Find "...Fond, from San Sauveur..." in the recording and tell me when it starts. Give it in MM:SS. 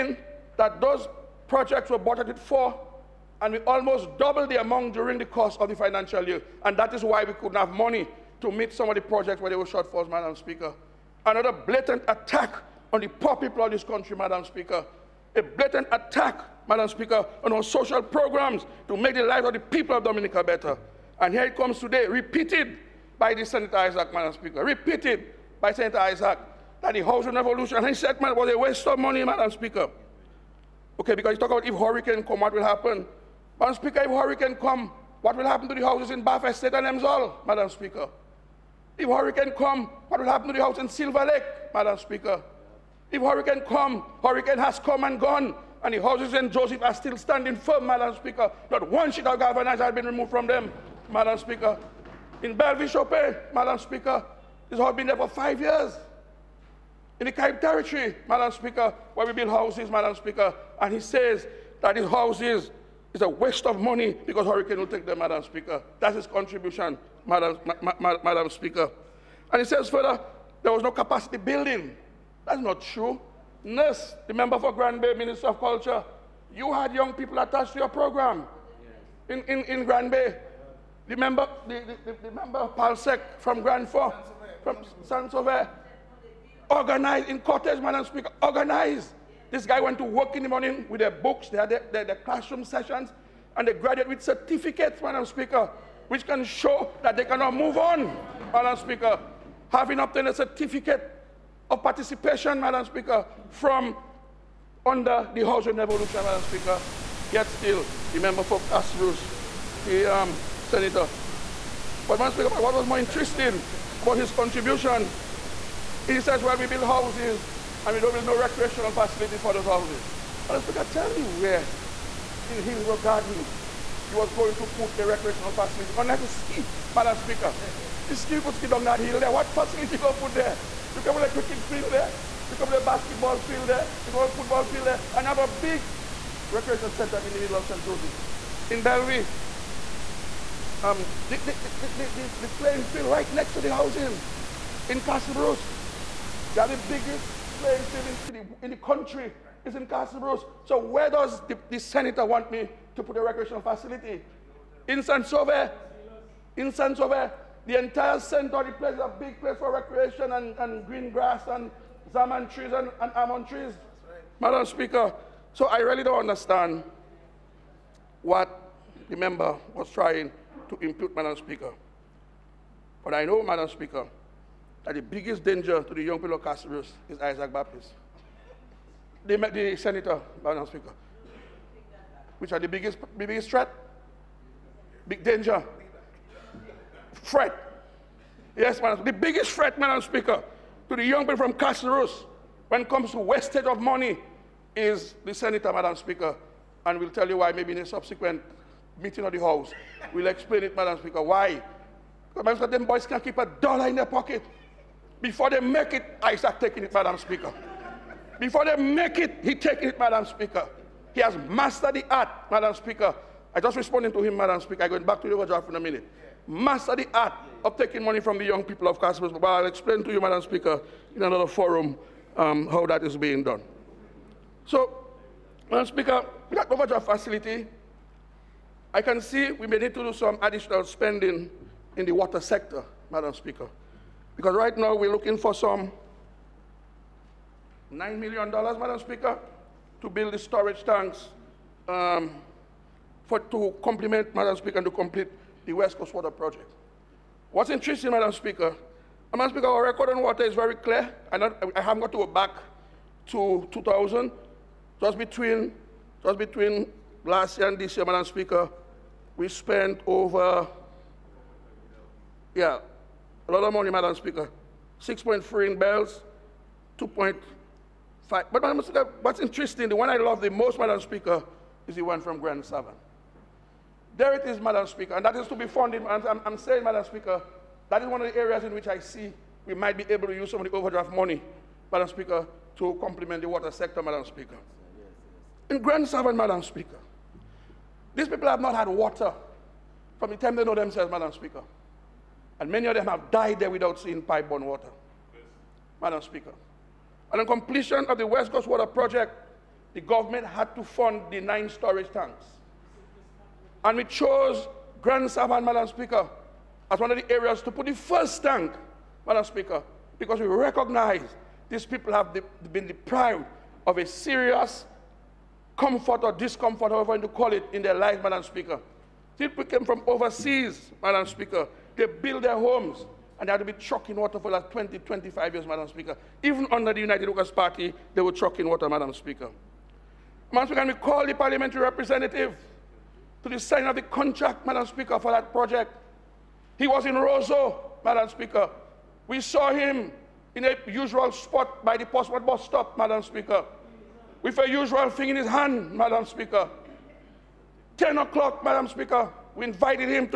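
01:23.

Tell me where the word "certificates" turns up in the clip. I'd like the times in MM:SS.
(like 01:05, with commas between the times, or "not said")
01:34, 01:40.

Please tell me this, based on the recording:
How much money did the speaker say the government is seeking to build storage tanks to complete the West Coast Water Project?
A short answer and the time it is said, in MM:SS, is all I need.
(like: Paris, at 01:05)
$9 million, at 03:57.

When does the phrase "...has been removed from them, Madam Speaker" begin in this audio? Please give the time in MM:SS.
00:49.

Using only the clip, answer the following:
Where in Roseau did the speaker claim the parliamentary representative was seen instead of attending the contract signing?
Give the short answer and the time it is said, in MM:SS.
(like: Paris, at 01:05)
Portsmouth bus stop, at 05:42.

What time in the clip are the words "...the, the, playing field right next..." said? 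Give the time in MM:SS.
02:21.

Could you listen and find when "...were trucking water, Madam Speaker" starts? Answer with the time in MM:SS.
05:28.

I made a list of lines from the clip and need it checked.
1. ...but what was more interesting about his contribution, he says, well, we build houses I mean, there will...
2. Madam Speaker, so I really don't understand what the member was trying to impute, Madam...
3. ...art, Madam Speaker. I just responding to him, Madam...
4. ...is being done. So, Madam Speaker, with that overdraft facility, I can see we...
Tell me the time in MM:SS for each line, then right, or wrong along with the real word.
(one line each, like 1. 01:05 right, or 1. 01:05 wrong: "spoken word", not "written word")
1. 01:52 right
2. 02:44 right
3. 03:32 right
4. 03:43 right.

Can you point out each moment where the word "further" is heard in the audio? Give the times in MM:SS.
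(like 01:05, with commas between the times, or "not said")
01:09.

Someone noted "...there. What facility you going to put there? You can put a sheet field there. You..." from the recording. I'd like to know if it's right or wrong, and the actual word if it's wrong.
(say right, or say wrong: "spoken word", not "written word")
wrong: "cricket", not "sheet".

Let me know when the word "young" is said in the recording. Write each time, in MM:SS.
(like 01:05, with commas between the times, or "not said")
01:16, 02:56, 03:11, 03:38.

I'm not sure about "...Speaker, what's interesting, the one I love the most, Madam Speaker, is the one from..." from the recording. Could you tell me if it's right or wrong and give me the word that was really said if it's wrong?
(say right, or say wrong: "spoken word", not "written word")
right.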